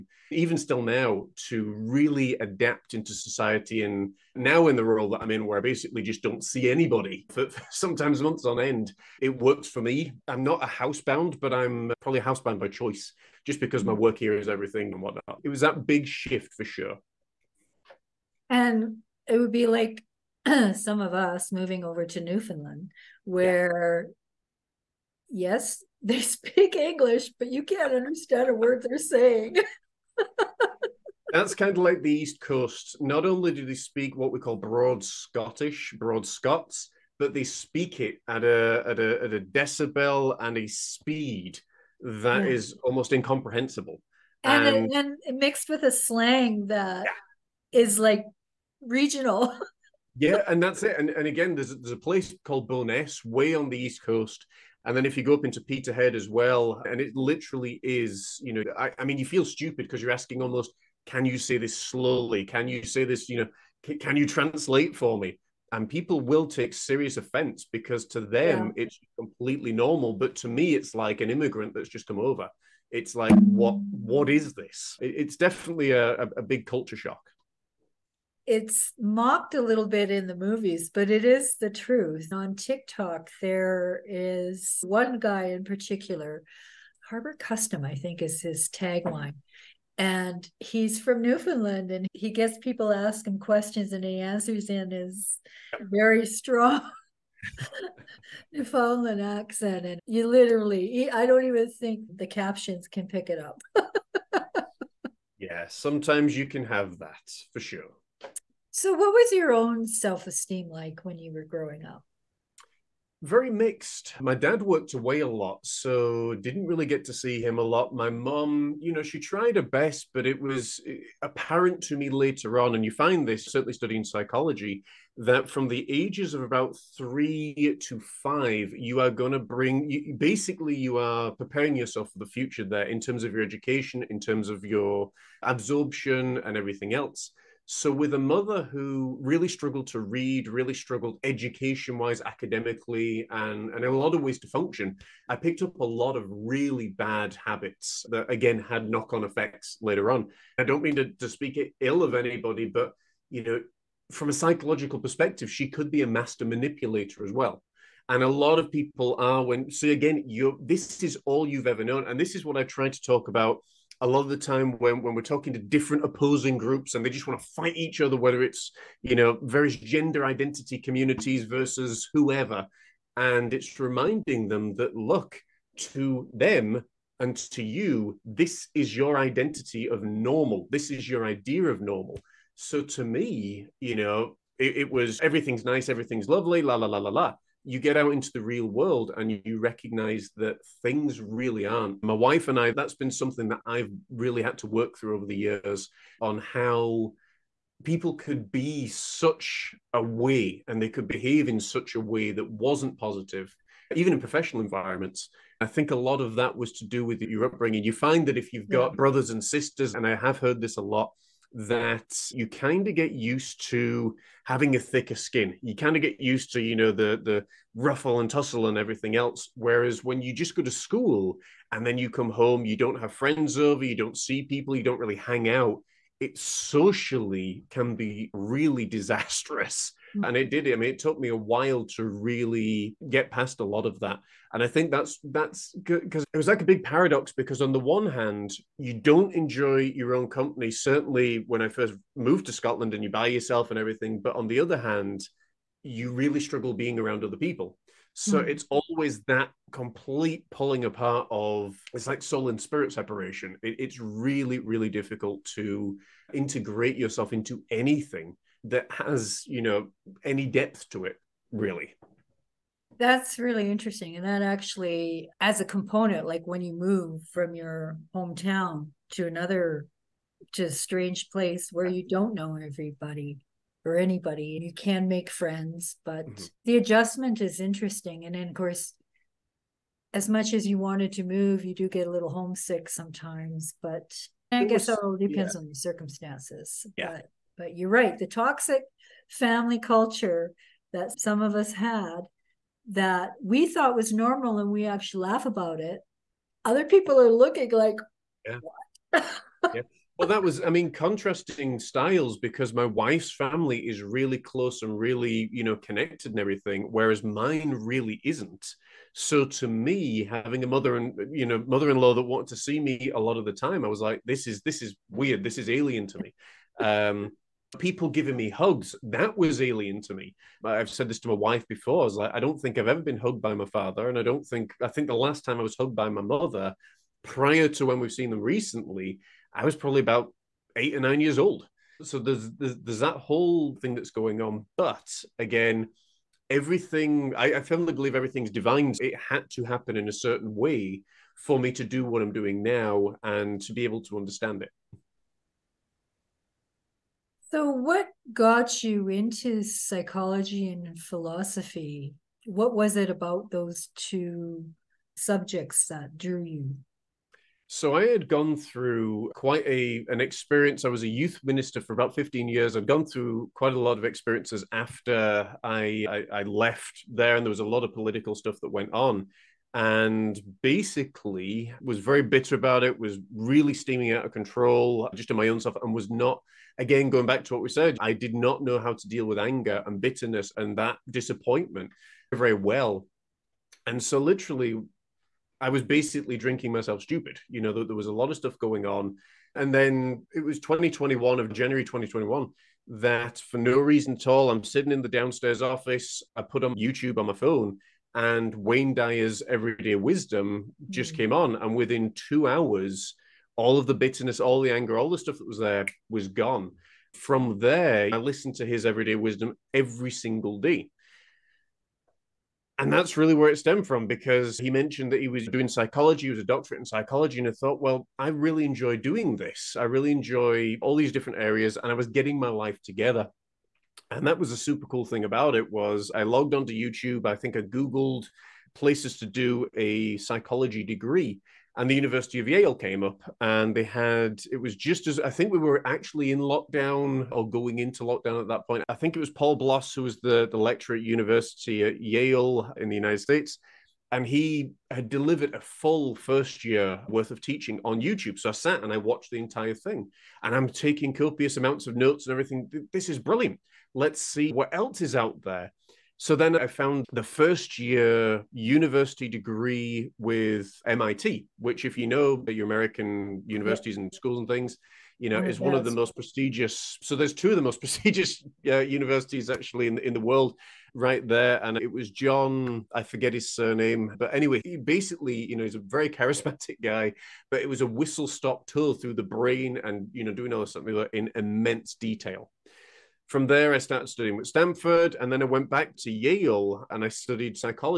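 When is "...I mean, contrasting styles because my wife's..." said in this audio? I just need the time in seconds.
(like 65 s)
300 s.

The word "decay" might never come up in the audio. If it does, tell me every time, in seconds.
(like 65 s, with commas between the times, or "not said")
not said.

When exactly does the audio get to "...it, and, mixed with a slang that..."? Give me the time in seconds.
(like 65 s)
44 s.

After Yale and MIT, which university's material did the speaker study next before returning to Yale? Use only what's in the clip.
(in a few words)
Stanford.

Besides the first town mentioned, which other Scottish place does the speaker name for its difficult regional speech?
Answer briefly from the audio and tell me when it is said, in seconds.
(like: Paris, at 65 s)
Peterhead, at 55 s.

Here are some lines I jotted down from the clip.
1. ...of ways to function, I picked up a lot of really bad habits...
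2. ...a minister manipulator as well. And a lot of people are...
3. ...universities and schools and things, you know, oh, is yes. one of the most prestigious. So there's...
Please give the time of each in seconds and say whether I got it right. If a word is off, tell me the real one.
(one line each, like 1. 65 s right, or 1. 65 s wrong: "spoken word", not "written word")
1. 144 s right
2. 156 s wrong: "master", not "minister"
3. 463 s right.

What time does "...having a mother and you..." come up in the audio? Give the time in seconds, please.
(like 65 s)
310 s.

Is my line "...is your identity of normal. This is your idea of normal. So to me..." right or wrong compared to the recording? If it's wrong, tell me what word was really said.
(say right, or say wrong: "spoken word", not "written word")
right.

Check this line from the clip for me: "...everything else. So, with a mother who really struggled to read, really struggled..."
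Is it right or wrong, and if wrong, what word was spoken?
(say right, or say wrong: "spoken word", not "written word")
right.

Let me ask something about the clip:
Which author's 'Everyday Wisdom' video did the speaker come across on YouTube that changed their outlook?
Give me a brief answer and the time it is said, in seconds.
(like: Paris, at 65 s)
Wayne Dyer, at 398 s.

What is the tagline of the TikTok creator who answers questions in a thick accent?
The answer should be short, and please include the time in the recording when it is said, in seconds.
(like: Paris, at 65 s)
Harbor Custom, at 87 s.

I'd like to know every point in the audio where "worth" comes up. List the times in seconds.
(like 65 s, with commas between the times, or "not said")
447 s.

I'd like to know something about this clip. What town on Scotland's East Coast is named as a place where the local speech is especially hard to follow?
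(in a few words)
Bo'ness.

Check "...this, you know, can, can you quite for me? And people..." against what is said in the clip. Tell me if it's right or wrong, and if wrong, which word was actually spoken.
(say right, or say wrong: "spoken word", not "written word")
wrong: "translate", not "quite".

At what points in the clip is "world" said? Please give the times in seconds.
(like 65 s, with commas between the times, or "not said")
188 s, 470 s.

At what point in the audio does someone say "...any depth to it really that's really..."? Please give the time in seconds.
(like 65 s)
260 s.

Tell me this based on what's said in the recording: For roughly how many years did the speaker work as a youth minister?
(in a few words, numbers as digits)
15.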